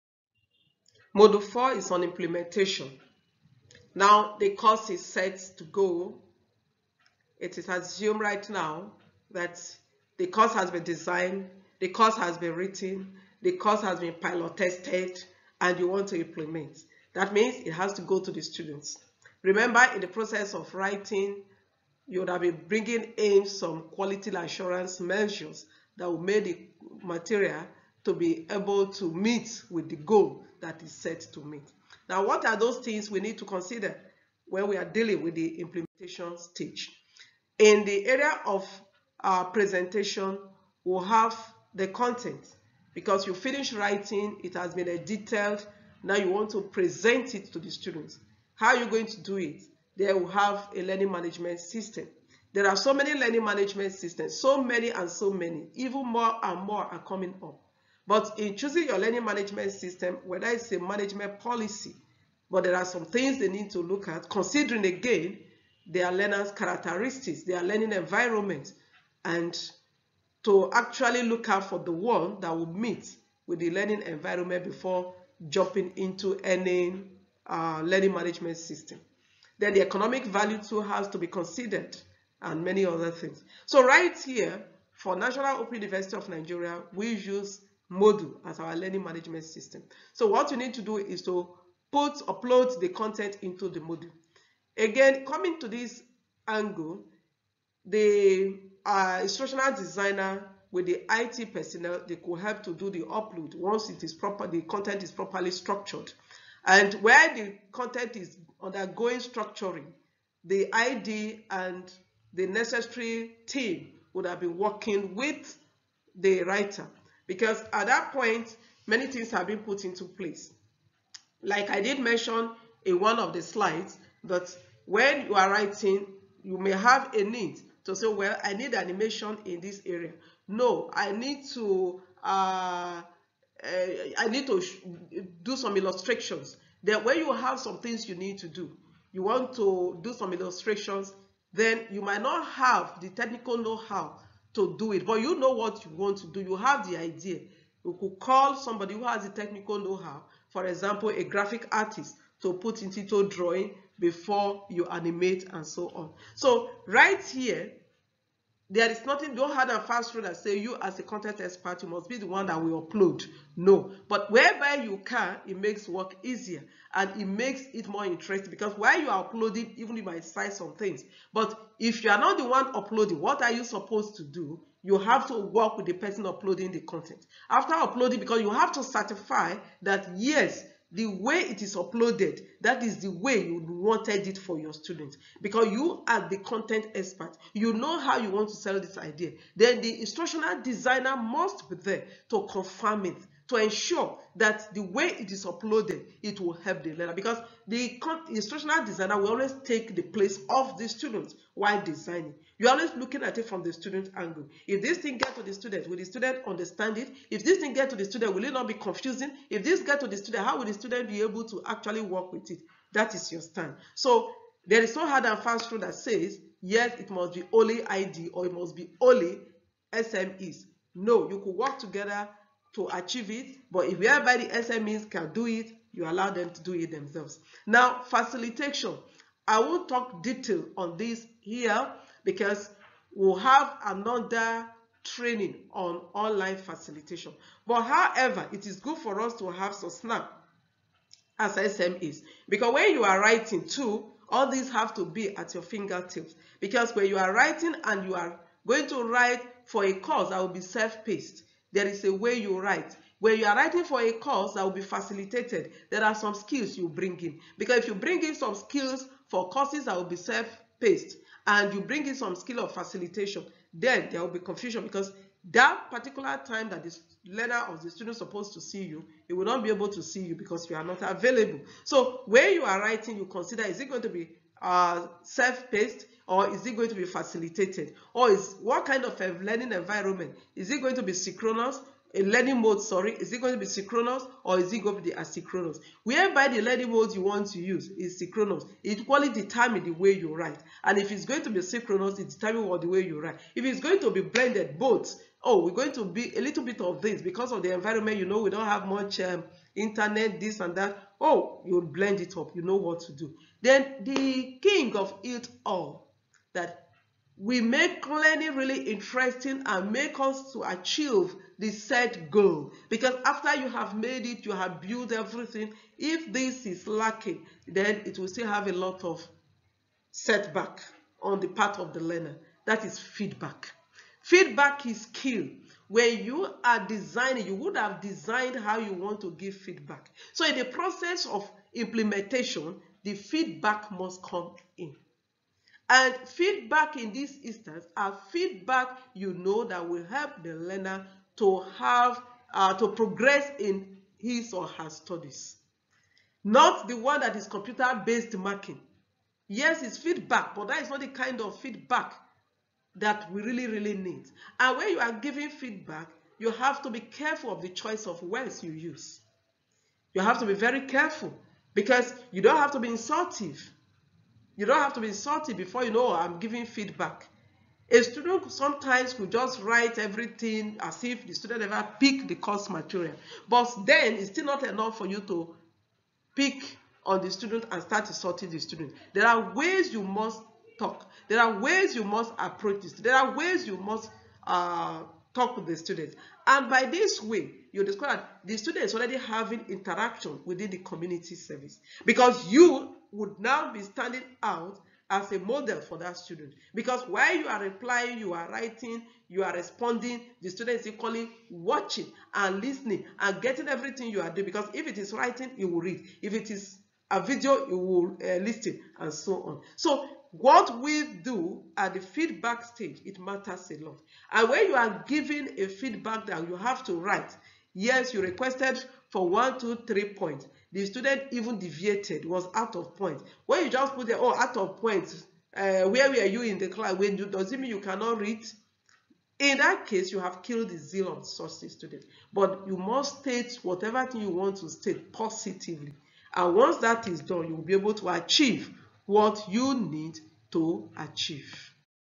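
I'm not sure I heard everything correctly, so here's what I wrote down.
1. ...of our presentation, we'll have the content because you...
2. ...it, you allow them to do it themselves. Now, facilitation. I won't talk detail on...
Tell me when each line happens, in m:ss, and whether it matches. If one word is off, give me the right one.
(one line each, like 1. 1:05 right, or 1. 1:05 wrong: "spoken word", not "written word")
1. 0:38 right
2. 3:45 right.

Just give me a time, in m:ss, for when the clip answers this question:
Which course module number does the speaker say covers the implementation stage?
0:01.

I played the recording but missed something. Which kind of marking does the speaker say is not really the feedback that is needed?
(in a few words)
computer-based marking.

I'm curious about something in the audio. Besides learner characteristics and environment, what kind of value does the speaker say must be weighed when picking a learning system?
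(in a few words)
economic value.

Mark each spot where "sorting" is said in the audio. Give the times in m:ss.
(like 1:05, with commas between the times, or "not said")
6:18.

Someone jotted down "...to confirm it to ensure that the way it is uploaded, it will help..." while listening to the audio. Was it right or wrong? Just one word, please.
right.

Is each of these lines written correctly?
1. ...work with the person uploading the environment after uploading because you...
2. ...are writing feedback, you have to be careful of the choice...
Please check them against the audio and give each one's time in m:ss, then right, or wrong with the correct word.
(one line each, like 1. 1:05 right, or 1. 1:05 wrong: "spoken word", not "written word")
1. 2:55 wrong: "content", not "environment"
2. 5:54 wrong: "giving", not "writing".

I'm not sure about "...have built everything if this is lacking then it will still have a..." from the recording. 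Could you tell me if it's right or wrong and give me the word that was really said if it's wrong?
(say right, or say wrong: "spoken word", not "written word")
right.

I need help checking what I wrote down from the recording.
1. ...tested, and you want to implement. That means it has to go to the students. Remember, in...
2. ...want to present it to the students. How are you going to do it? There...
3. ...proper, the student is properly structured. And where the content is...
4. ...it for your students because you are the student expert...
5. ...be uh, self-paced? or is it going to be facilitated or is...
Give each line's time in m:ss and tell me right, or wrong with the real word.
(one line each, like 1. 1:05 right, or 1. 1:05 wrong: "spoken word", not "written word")
1. 0:14 right
2. 0:46 right
3. 1:44 wrong: "content", not "student"
4. 3:04 wrong: "content", not "student"
5. 4:34 right.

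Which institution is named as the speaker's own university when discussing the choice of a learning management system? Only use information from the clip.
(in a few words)
National Open University of Nigeria.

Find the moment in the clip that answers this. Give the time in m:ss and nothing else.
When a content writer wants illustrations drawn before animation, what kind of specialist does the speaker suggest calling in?
2:31.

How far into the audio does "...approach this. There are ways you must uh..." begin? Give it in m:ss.
6:22.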